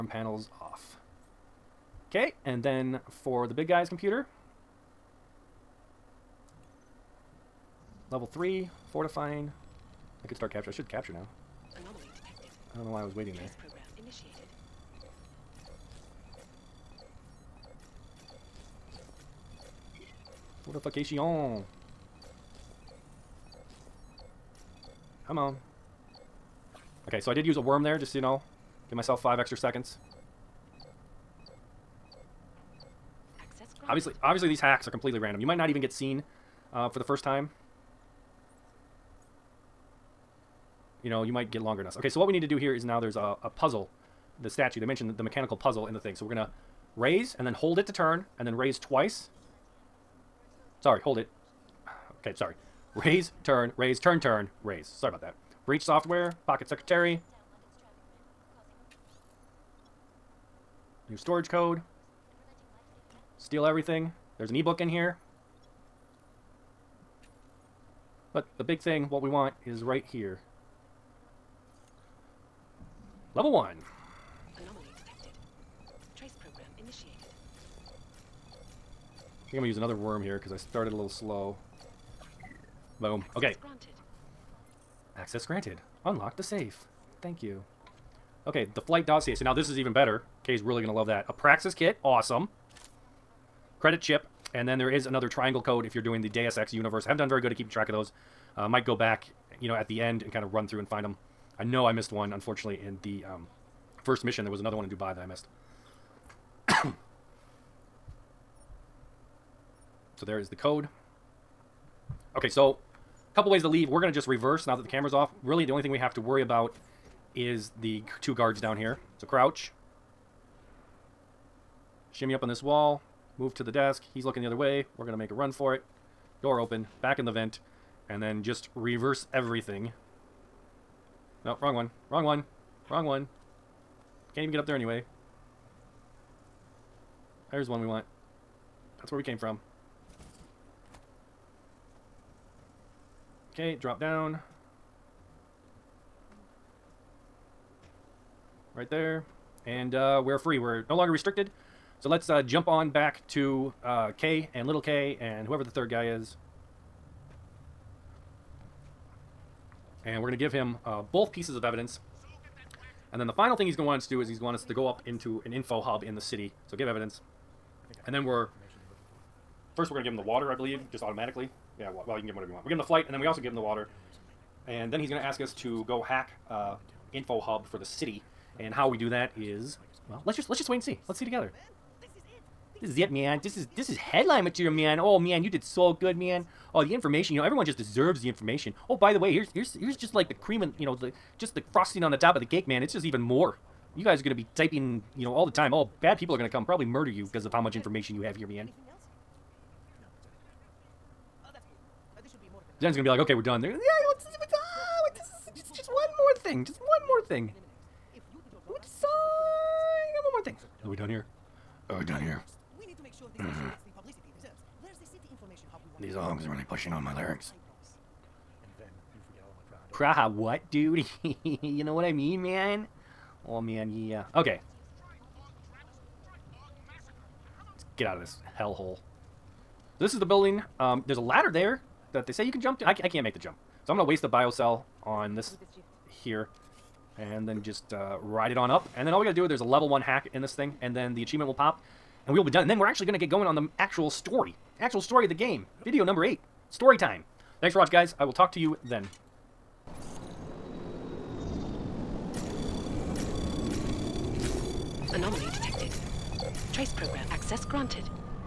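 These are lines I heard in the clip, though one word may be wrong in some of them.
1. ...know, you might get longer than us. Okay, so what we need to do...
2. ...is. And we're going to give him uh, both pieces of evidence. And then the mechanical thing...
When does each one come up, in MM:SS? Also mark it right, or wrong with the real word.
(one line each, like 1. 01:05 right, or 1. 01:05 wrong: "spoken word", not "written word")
1. 00:41 right
2. 02:36 wrong: "final", not "mechanical".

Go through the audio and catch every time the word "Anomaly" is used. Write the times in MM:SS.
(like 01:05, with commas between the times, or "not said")
00:11, 01:14, 04:15.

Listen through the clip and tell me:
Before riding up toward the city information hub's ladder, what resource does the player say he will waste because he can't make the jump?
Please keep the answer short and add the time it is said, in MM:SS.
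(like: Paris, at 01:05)
a bio cell, at 03:54.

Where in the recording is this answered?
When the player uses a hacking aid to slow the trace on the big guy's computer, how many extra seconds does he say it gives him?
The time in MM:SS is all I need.
00:29.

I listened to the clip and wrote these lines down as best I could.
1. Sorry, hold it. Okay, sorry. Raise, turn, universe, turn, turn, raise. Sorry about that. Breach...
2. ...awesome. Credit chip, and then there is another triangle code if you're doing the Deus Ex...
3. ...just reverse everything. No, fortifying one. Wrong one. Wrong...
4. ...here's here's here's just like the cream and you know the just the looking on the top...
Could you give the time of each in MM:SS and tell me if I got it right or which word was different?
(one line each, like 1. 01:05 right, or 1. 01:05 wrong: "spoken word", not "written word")
1. 00:50 wrong: "raise", not "universe"
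2. 01:32 right
3. 02:08 wrong: "wrong", not "fortifying"
4. 03:09 wrong: "frosting", not "looking".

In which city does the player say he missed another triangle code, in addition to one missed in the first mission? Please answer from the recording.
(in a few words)
Dubai.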